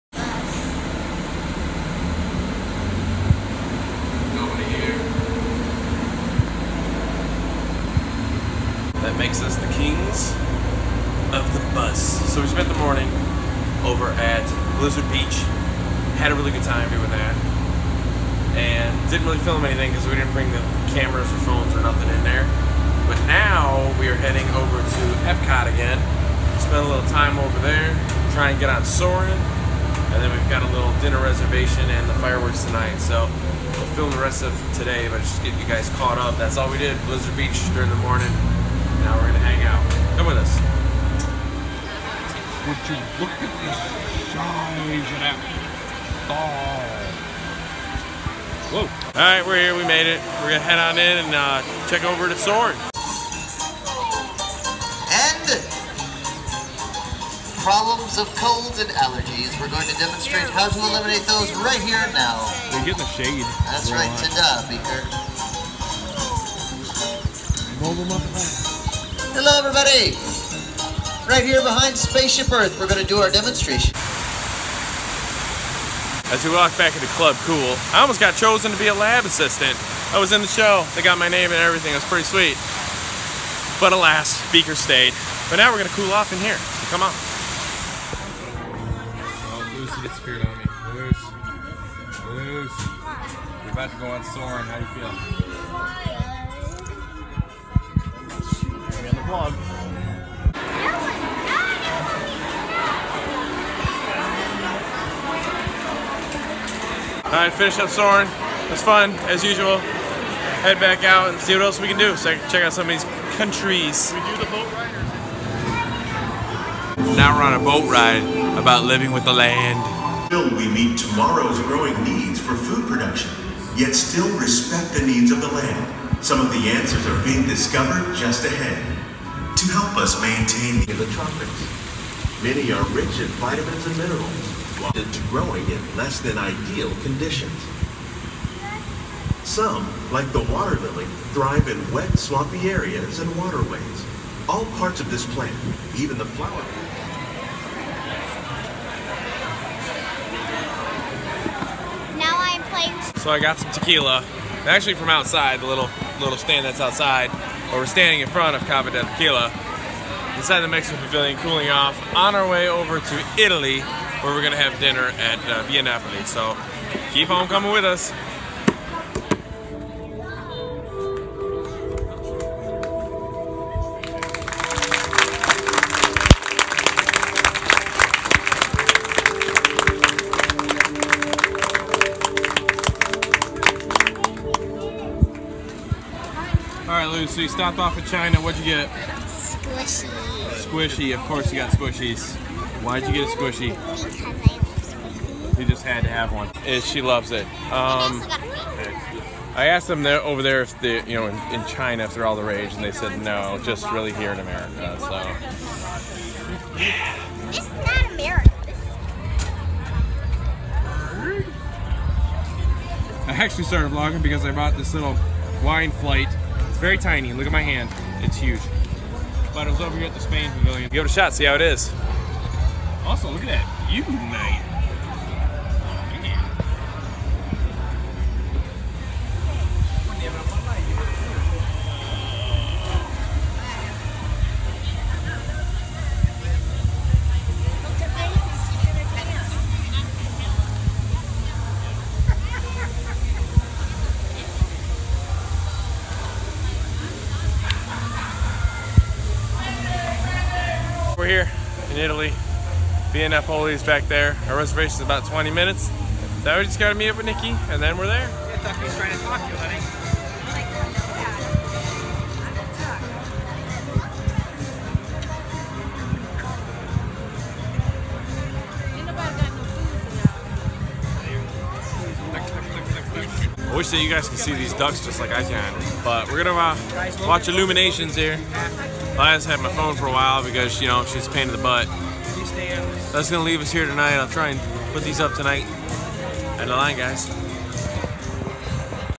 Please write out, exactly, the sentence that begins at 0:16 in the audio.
Had a really good time doing that.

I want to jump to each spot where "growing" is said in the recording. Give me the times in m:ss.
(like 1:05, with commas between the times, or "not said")
2:01, 2:15.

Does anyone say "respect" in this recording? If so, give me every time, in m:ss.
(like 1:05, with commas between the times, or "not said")
2:04.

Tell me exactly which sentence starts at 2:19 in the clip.
Some, like the water lily, thrive in wet, swampy areas and waterways.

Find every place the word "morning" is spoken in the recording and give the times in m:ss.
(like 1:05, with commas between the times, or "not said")
0:12, 0:38.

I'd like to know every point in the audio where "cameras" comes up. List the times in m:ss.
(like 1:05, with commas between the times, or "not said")
0:20.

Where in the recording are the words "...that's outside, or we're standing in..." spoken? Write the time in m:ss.
2:36.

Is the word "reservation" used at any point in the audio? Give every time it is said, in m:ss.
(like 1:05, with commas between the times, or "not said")
0:31, 4:14.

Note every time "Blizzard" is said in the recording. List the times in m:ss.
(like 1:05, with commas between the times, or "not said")
0:14, 0:37.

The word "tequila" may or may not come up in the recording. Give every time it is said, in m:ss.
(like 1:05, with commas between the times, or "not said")
2:33, 2:39.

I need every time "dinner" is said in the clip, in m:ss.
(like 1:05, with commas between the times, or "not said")
0:31, 2:44.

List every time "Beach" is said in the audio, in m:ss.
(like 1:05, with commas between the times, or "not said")
0:15, 0:37.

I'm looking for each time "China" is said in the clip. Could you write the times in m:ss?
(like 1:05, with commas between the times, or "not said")
3:08, 3:21.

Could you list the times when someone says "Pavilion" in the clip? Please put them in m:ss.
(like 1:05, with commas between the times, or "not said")
2:41, 3:40.